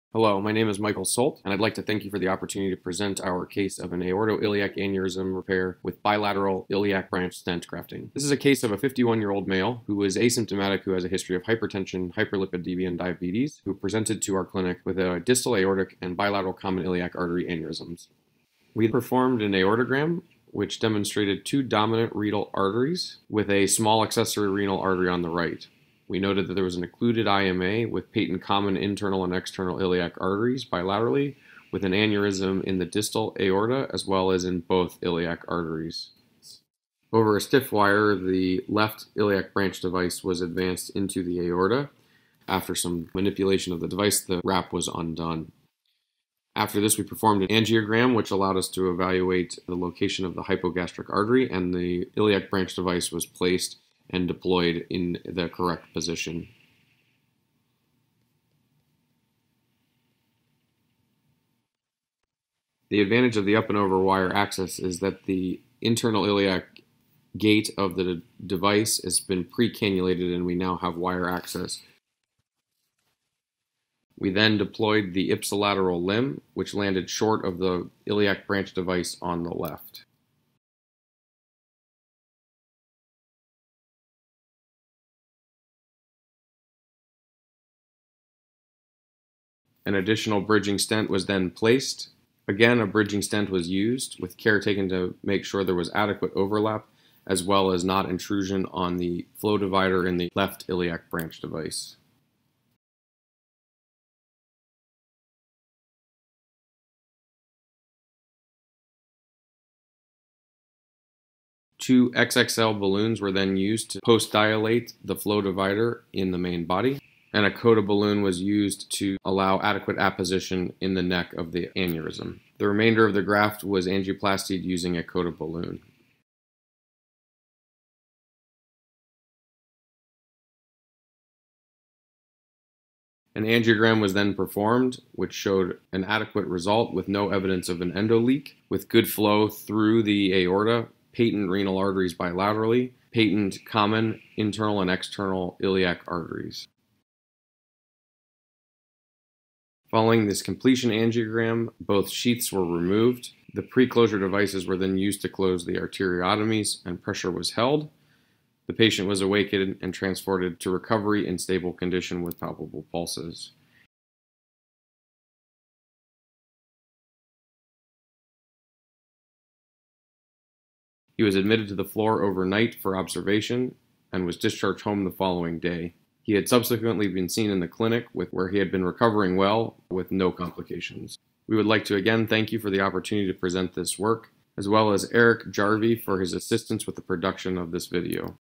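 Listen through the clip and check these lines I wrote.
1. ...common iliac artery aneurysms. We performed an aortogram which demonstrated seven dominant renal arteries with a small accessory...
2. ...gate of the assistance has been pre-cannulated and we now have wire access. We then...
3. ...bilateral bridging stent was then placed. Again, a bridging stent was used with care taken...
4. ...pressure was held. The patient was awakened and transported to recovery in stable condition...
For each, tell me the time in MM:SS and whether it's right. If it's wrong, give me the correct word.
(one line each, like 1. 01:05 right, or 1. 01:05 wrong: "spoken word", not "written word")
1. 00:16 wrong: "two", not "seven"
2. 01:07 wrong: "device", not "assistance"
3. 01:29 wrong: "additional", not "bilateral"
4. 02:37 right.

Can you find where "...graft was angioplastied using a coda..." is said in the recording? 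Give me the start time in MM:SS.
02:03.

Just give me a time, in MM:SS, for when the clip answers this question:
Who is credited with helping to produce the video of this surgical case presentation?
03:05.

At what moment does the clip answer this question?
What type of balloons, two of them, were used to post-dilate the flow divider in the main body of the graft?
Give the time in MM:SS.
01:52.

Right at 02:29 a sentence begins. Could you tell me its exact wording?
Following this completion angiogram, both sheaths were removed.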